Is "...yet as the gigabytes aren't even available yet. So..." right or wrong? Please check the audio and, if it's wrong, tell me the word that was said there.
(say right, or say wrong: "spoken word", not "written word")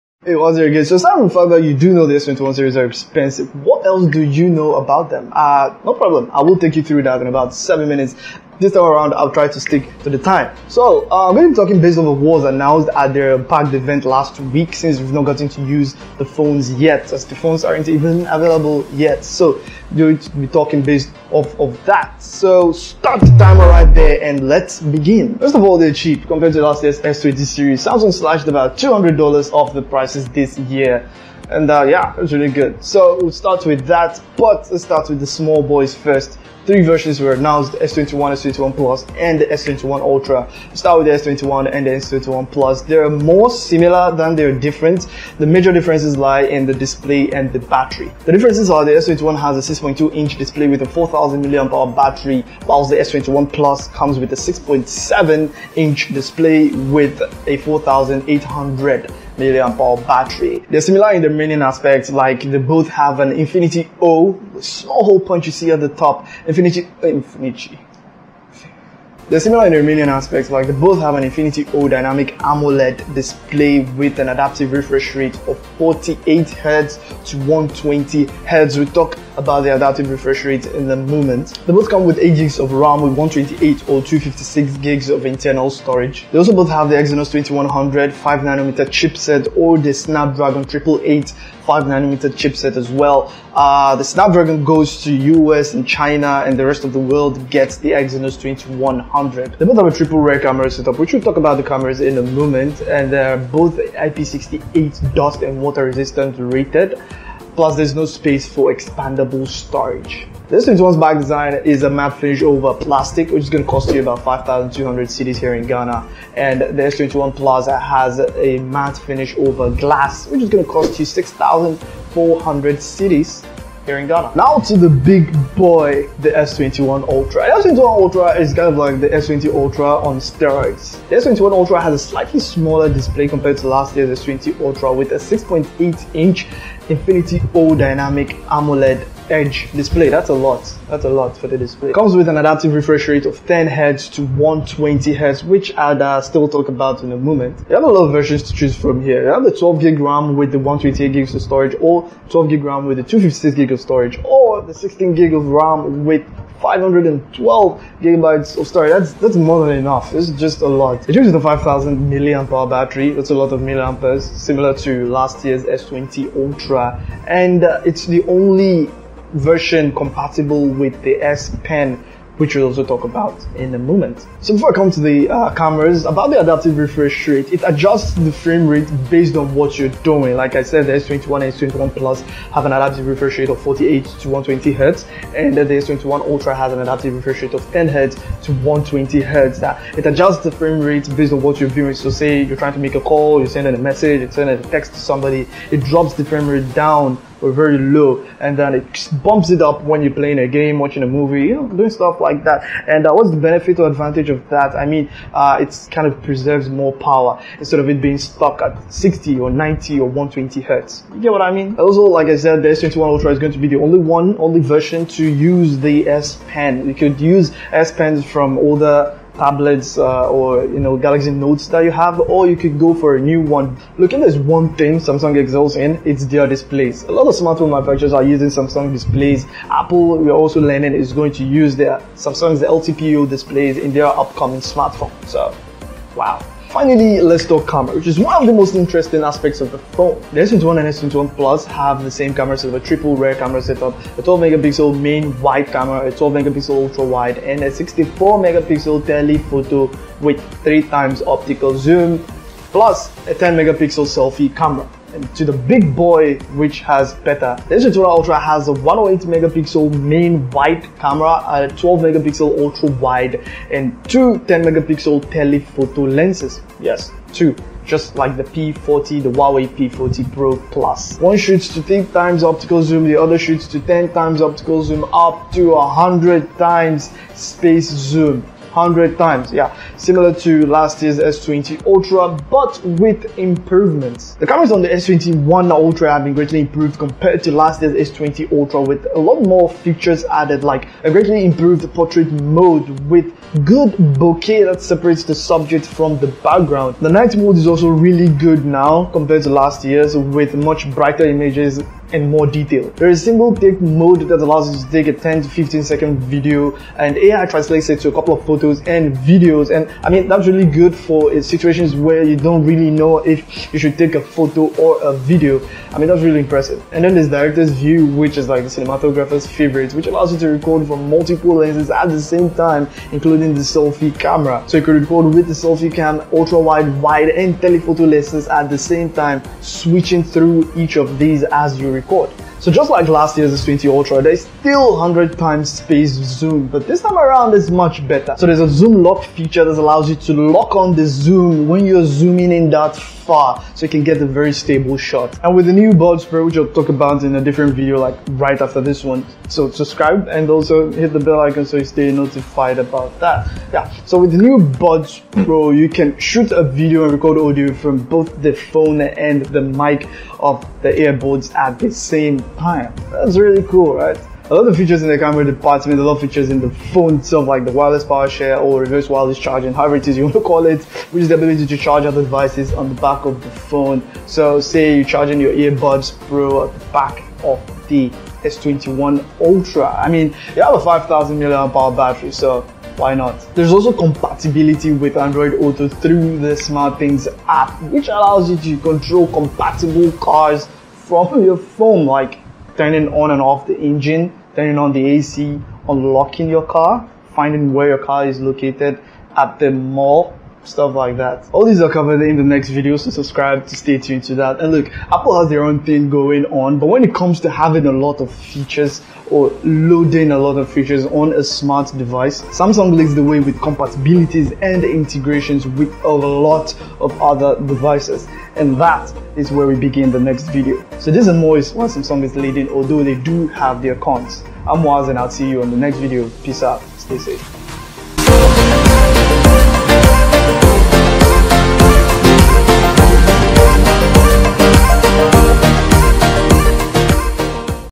wrong: "phones", not "gigabytes".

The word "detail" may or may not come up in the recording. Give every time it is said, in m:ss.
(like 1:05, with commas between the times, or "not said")
5:02.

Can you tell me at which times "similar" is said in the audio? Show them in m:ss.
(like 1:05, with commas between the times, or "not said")
0:43, 1:00, 1:09, 2:44, 4:39.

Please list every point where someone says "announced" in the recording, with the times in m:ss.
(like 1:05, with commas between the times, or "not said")
0:12, 0:37.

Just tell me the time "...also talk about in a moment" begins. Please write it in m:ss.
2:52.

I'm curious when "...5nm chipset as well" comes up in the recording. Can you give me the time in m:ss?
1:31.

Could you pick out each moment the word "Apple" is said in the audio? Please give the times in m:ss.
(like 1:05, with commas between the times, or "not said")
3:49, 6:45.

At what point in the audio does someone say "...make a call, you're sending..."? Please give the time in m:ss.
3:12.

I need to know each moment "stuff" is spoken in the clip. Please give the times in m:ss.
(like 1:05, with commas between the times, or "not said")
3:21, 6:40.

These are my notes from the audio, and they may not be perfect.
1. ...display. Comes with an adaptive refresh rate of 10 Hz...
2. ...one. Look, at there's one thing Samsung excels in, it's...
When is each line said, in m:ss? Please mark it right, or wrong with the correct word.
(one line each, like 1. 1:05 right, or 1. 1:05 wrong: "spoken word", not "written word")
1. 2:21 right
2. 3:43 right.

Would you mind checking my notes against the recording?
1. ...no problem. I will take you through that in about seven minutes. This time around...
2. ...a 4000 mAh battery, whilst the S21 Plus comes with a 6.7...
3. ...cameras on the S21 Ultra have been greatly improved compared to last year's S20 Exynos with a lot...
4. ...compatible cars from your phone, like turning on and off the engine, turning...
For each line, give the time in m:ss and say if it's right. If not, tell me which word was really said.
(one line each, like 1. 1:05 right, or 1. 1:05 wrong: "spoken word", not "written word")
1. 0:05 right
2. 0:50 right
3. 4:44 wrong: "Ultra", not "Exynos"
4. 6:29 right.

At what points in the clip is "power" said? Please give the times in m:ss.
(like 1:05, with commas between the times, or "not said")
3:26, 6:08.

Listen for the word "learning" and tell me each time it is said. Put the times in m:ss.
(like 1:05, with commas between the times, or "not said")
3:50.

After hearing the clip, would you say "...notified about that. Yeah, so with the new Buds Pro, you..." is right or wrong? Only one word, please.
right.